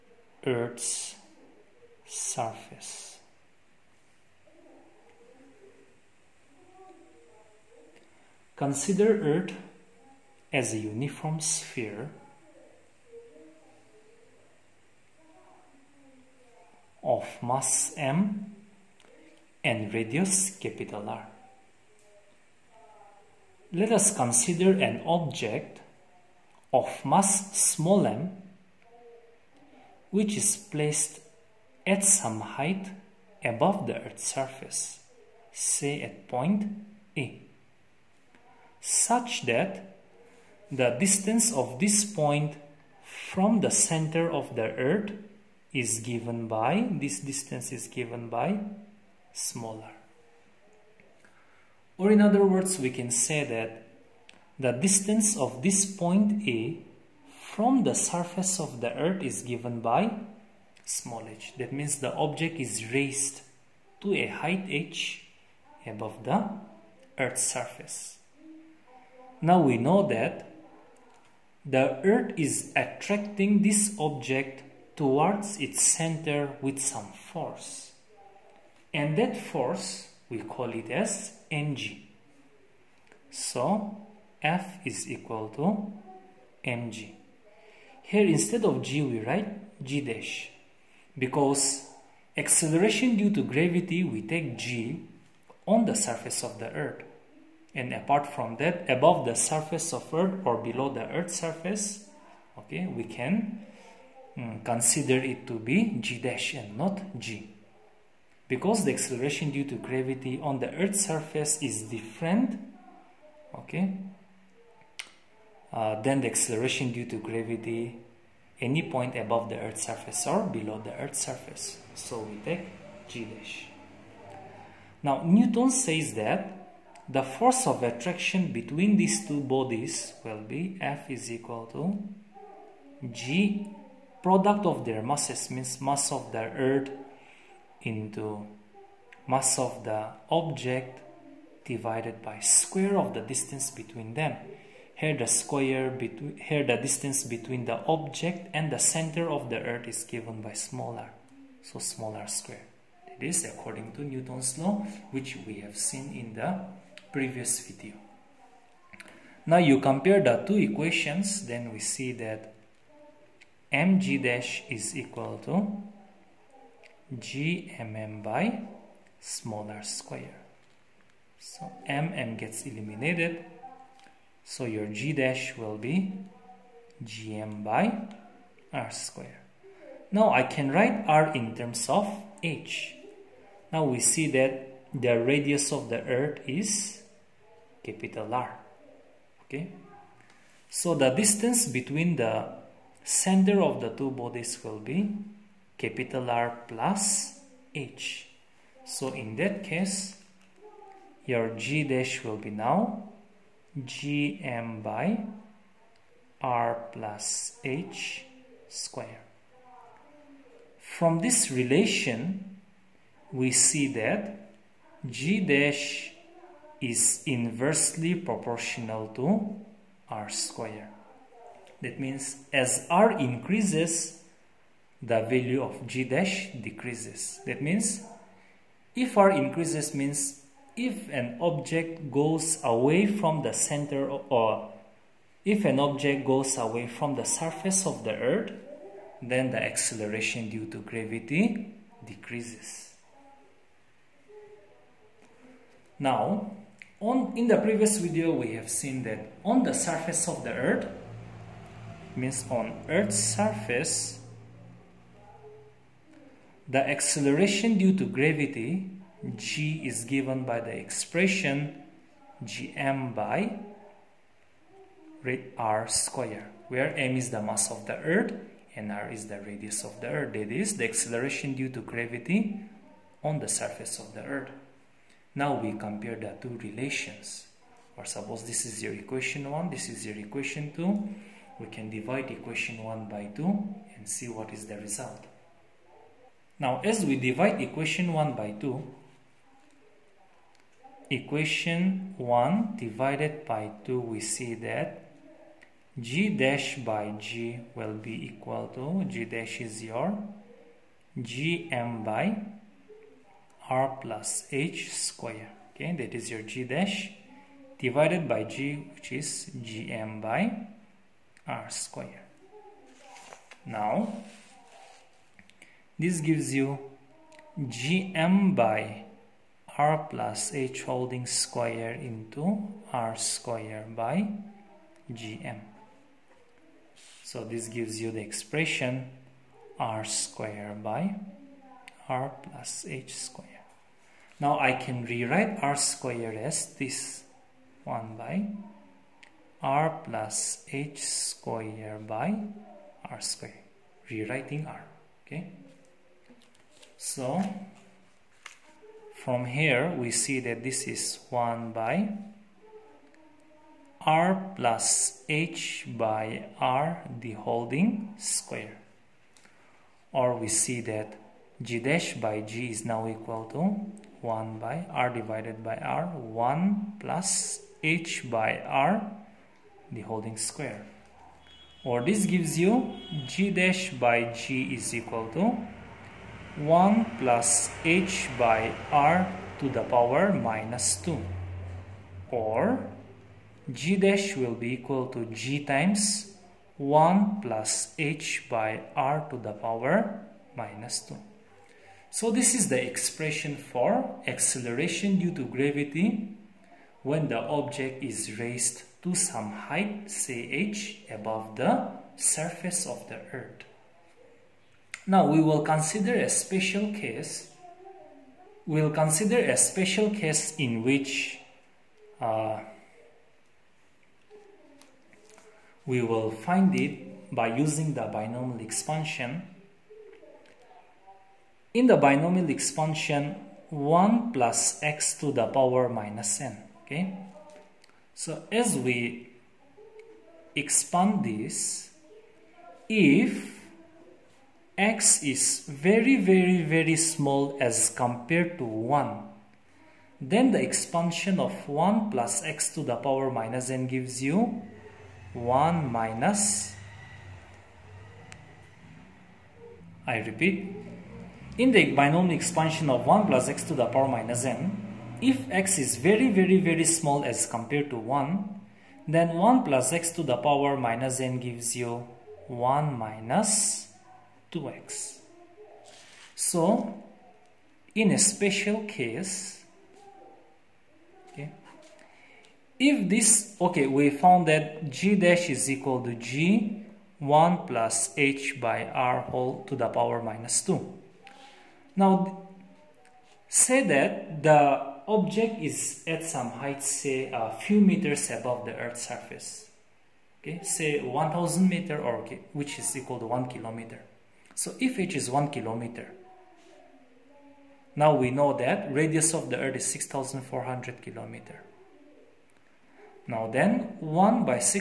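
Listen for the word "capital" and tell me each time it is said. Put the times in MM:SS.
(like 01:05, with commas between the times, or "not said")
00:20, 03:07, 03:15.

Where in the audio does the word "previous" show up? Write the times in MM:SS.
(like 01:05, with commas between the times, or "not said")
02:37, 04:07.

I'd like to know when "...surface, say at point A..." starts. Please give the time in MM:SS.
00:34.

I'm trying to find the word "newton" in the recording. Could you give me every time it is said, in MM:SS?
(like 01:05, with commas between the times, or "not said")
02:05, 02:34.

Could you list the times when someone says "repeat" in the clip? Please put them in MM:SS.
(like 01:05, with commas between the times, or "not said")
07:30.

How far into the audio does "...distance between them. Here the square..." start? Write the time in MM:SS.
02:23.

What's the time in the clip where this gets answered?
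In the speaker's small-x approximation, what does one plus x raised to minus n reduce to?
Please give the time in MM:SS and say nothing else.
07:42.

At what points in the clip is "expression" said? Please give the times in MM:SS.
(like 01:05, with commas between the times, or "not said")
04:20, 05:28, 06:32.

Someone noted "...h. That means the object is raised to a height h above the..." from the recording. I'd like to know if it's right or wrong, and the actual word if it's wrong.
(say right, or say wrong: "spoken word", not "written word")
right.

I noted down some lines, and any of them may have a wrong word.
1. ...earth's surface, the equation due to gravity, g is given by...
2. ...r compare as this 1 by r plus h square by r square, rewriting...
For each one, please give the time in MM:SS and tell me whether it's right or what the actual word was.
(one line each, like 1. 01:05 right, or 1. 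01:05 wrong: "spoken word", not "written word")
1. 04:12 wrong: "acceleration", not "equation"
2. 05:35 wrong: "square", not "compare".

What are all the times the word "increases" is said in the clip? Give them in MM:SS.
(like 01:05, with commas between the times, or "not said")
03:43, 03:49.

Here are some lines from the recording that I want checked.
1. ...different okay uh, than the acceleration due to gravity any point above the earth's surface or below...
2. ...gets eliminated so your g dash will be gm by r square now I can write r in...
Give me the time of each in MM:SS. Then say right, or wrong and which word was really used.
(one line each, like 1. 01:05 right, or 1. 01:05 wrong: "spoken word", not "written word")
1. 01:51 right
2. 02:52 right.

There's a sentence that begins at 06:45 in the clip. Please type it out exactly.
Now we will consider a special case.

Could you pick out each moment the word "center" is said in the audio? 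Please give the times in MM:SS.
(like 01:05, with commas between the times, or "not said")
00:43, 01:15, 02:28, 03:13, 03:53.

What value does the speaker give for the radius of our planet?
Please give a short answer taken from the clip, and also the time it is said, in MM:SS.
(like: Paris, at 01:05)
6,400 kilometers, at 08:19.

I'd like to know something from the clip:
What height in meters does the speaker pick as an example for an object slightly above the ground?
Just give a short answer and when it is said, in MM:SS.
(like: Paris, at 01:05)
1000 meters, at 08:11.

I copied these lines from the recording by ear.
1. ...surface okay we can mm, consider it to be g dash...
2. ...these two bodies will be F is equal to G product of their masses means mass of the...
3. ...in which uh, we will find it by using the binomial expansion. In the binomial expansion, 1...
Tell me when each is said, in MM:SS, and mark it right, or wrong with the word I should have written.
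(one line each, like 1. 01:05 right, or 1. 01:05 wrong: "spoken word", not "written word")
1. 01:41 right
2. 02:08 right
3. 06:50 right.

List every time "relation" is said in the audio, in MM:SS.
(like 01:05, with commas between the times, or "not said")
03:31, 04:36.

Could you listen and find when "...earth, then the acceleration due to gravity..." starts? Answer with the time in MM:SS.
03:58.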